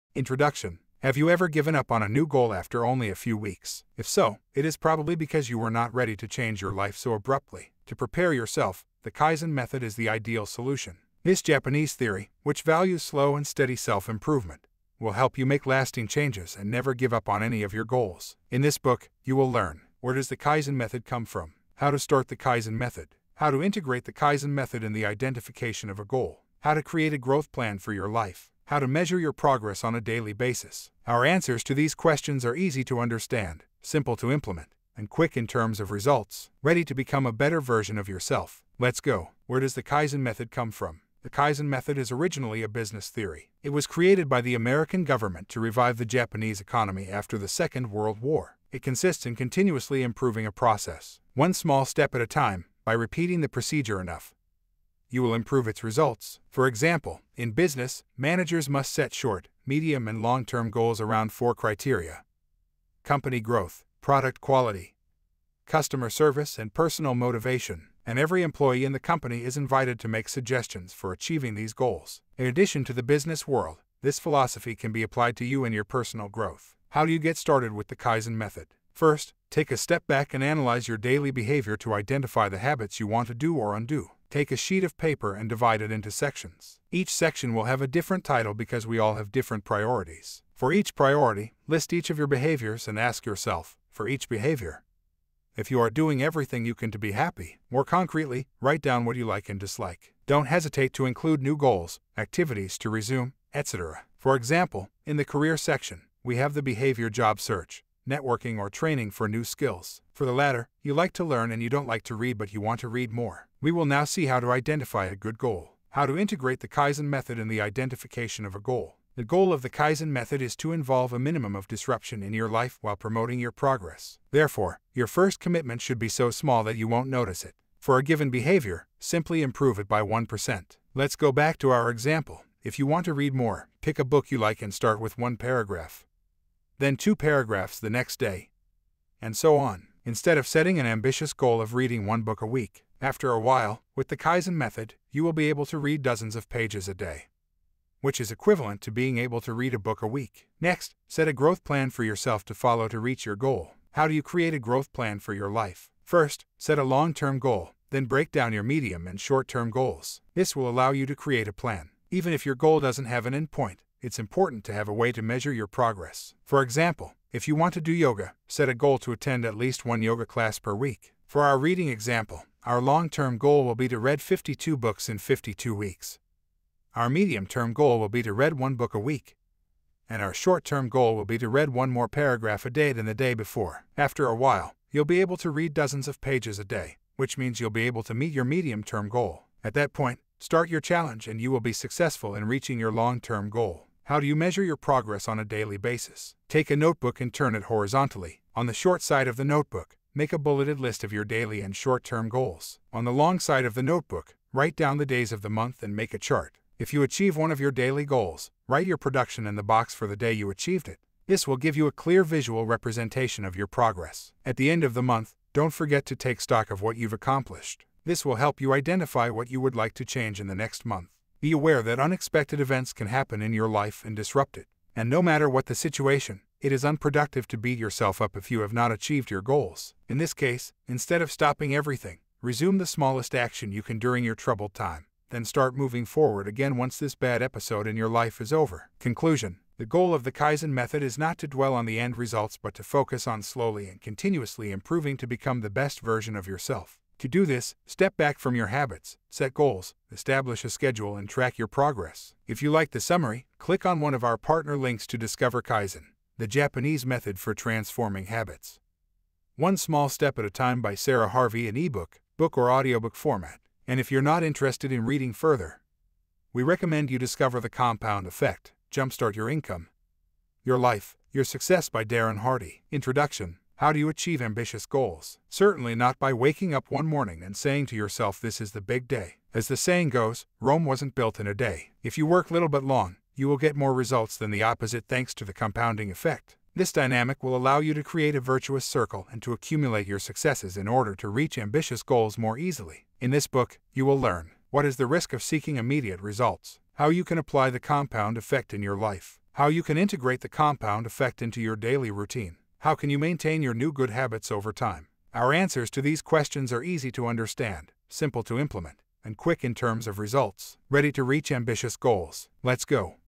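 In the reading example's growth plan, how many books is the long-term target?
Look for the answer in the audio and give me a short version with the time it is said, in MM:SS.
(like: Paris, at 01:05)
52, at 02:54.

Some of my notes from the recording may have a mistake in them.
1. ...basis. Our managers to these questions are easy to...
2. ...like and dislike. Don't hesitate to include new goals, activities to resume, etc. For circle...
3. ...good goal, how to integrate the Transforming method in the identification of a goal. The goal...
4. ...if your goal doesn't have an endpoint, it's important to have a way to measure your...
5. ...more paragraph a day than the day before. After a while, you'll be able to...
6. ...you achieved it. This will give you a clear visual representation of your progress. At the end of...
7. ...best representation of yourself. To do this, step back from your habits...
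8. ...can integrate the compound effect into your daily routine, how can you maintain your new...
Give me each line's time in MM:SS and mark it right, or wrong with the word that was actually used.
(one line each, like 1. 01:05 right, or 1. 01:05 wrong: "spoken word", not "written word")
1. 00:30 wrong: "answers", not "managers"
2. 01:39 wrong: "example", not "circle"
3. 01:55 wrong: "Kaizen", not "Transforming"
4. 02:42 right
5. 03:01 right
6. 03:30 right
7. 04:05 wrong: "version", not "representation"
8. 04:59 right.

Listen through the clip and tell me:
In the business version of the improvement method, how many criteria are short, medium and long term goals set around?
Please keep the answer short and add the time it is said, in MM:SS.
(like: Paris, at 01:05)
4, at 01:01.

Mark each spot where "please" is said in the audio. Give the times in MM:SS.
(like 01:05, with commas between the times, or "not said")
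not said.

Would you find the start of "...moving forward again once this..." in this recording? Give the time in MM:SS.
03:55.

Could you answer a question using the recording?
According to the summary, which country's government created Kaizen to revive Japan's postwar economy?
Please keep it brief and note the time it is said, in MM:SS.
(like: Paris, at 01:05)
American, at 00:44.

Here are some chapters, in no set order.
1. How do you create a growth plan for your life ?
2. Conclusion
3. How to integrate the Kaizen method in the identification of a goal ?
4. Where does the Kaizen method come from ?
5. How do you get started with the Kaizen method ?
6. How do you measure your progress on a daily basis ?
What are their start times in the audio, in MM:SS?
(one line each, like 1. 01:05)
1. 02:33
2. 03:59
3. 01:55
4. 00:39
5. 01:16
6. 03:14.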